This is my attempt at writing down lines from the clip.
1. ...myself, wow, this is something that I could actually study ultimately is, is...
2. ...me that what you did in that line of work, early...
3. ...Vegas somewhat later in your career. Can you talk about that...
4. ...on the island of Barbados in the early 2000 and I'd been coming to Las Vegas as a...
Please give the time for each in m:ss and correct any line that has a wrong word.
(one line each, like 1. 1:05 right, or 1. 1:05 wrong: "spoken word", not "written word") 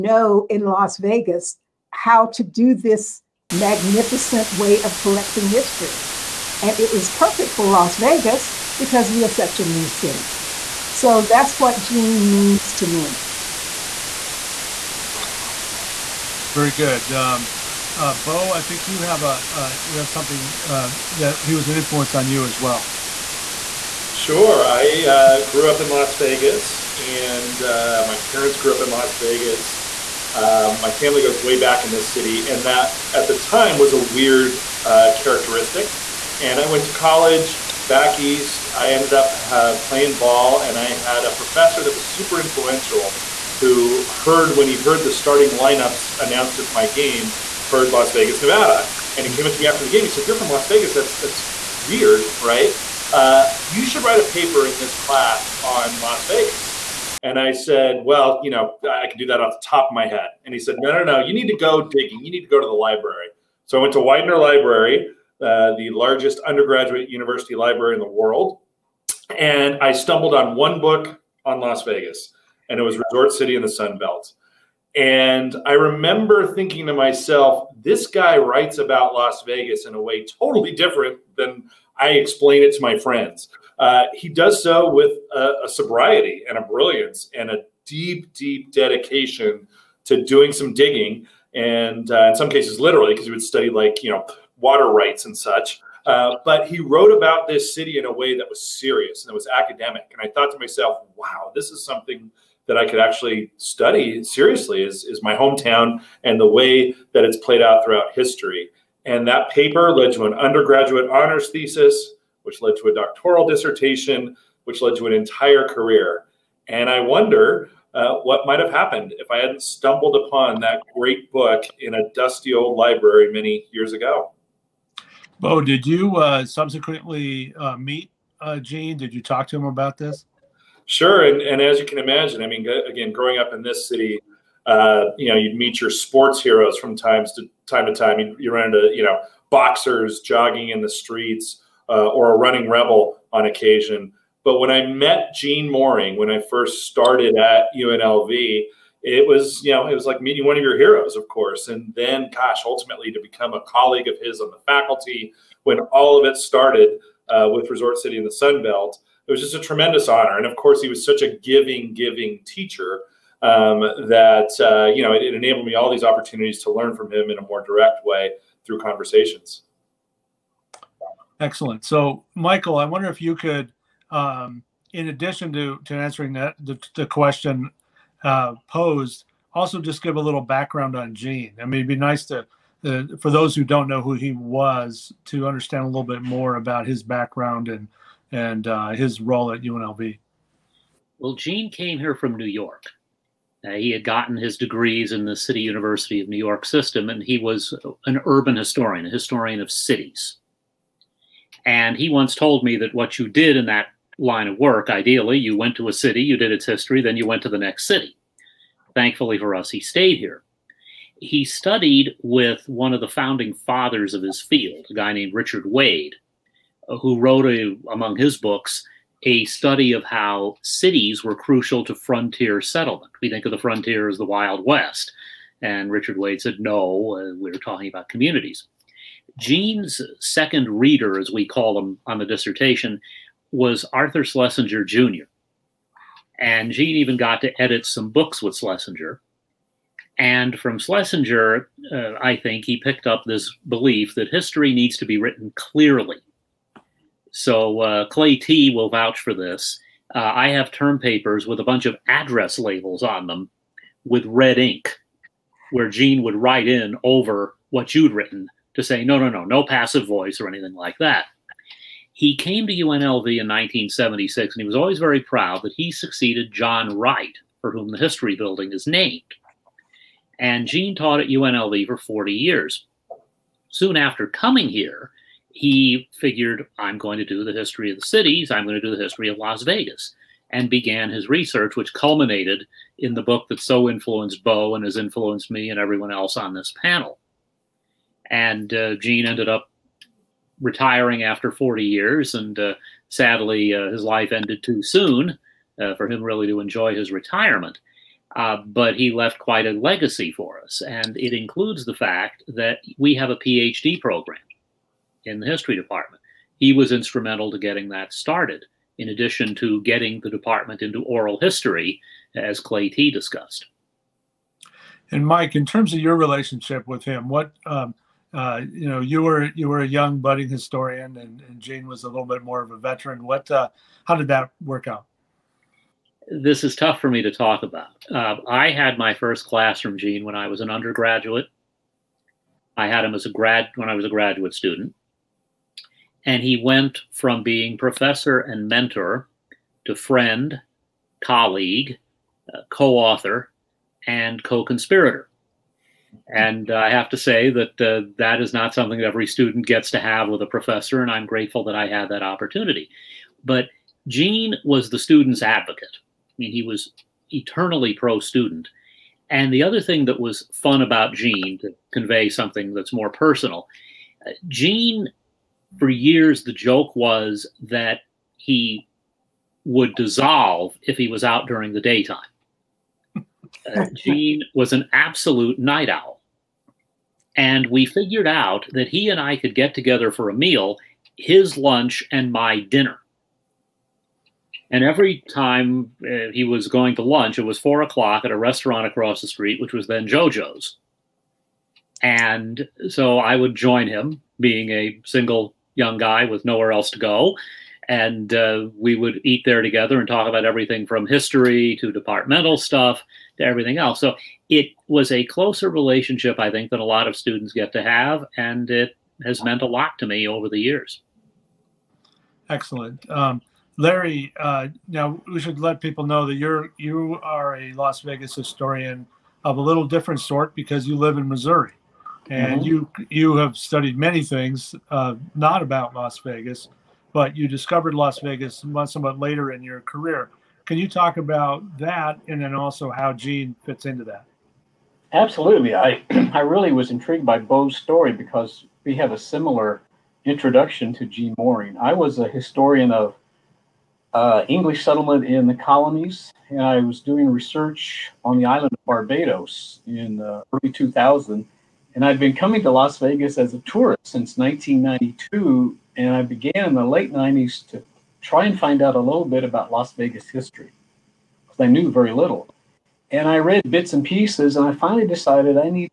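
1. 1:40 wrong: "seriously", not "ultimately"
2. 3:22 wrong: "ideally", not "early"
3. 7:08 right
4. 7:28 right.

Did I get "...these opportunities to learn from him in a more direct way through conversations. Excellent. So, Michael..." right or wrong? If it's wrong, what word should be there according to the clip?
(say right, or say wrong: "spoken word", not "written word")
right.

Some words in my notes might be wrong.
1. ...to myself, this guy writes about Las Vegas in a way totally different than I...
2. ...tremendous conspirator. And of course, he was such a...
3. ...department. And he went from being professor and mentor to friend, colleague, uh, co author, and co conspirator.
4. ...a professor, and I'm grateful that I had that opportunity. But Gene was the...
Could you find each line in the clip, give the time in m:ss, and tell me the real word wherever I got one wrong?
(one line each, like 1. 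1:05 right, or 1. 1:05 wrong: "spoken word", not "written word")
1. 1:16 right
2. 2:39 wrong: "honor", not "conspirator"
3. 5:34 wrong: "student", not "department"
4. 5:50 right.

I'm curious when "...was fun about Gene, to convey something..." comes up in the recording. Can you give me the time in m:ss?
6:00.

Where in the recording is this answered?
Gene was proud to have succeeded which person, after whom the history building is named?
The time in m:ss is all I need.
4:26.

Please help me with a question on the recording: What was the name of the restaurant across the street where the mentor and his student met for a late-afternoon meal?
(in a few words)
JoJo's.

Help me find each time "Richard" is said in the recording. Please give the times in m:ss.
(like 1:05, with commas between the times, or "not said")
3:35, 3:45.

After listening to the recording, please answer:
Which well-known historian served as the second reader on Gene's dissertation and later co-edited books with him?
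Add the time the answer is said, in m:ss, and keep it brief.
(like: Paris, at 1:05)
Arthur Schlesinger Jr., at 3:53.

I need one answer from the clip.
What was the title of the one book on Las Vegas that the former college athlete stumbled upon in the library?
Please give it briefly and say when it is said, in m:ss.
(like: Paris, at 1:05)
Resort City in the Sun Belt, at 1:12.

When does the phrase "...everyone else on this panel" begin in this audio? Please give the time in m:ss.
4:45.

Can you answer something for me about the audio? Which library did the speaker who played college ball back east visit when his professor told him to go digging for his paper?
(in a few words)
Widener Library.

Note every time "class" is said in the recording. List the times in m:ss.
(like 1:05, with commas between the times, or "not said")
0:54, 5:29.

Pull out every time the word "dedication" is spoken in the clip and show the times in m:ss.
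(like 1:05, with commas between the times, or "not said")
1:28.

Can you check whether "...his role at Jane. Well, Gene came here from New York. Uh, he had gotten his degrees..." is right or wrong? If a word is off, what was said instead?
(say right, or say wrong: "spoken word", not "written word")
wrong: "UNLV", not "Jane".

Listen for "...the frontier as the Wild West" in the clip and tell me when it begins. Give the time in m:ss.
3:43.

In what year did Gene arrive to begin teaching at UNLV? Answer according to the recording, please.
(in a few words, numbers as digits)
1976.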